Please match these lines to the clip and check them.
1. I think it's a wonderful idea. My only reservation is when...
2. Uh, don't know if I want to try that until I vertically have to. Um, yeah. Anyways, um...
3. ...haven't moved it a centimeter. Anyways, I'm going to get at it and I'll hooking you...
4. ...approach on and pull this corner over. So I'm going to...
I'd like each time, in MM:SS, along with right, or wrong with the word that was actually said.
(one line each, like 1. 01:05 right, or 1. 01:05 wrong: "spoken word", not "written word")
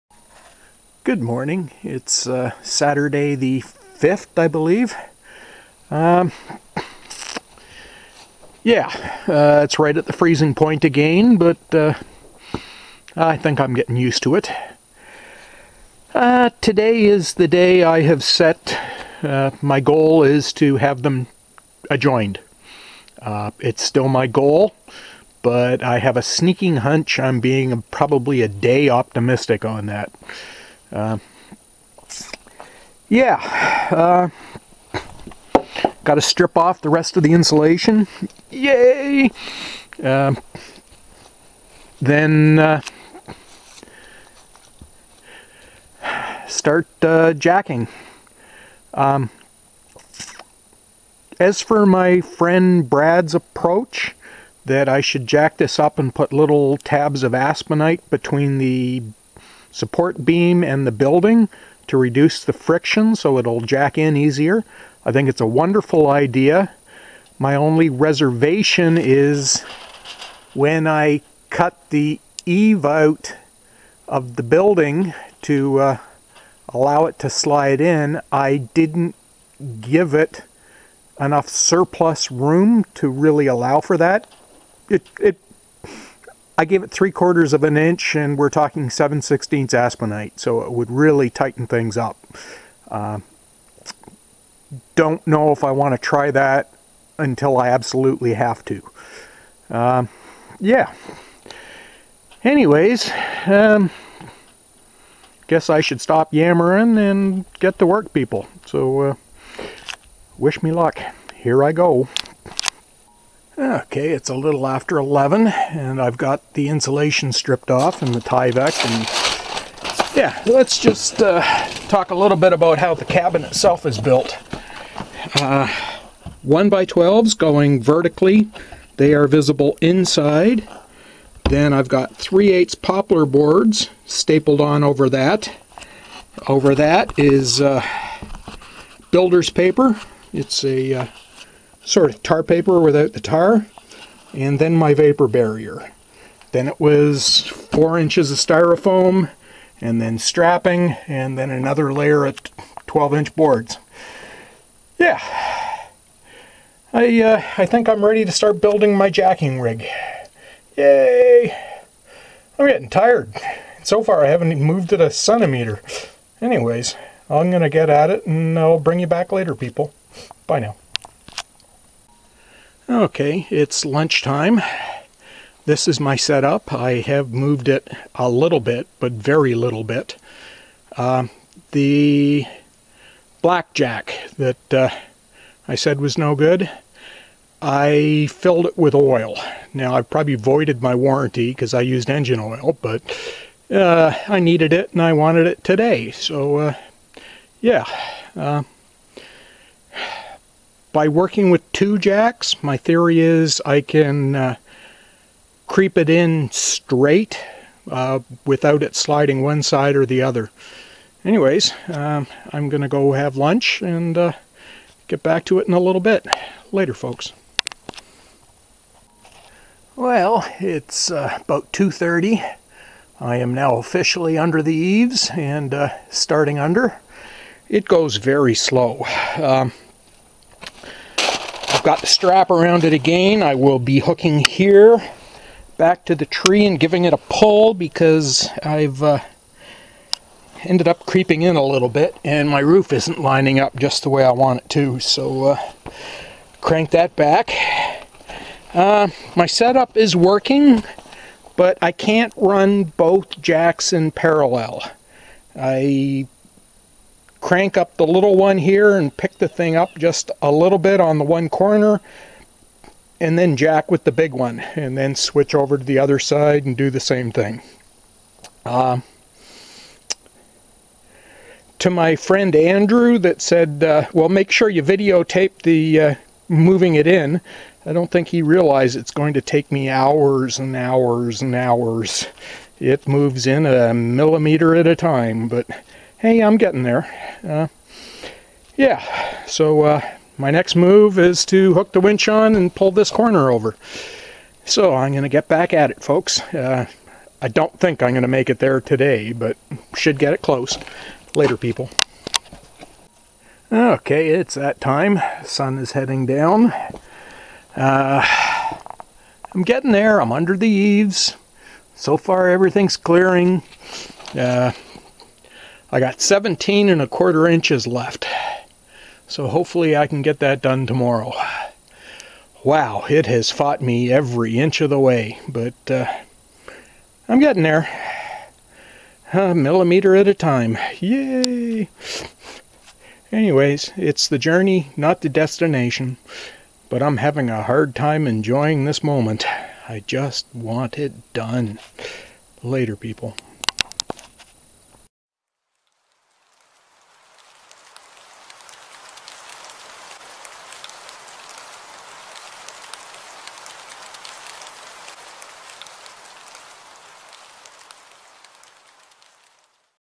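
1. 01:05 right
2. 01:32 wrong: "absolutely", not "vertically"
3. 02:44 wrong: "bring", not "hooking"
4. 04:51 wrong: "winch", not "approach".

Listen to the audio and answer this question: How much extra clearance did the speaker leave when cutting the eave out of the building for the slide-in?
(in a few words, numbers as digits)
3/4 inch.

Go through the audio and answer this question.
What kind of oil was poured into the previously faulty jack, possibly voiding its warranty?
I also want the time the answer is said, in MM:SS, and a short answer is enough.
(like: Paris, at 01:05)
engine oil, at 03:12.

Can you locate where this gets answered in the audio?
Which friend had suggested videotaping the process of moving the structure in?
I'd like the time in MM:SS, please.
04:32.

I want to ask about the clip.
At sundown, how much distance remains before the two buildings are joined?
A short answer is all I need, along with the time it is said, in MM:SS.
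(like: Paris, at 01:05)
17 1/4 inches, at 05:16.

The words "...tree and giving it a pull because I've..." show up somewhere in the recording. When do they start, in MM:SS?
03:56.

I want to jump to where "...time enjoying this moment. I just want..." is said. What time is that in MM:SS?
05:37.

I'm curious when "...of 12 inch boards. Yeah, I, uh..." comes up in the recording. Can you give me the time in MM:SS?
02:32.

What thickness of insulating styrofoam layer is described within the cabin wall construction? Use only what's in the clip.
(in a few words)
4 inches.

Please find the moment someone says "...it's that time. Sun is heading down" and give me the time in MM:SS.
05:04.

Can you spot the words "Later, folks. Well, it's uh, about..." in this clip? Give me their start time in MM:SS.
03:36.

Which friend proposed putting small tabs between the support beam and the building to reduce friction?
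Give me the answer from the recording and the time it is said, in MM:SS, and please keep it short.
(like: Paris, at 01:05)
Brad, at 00:52.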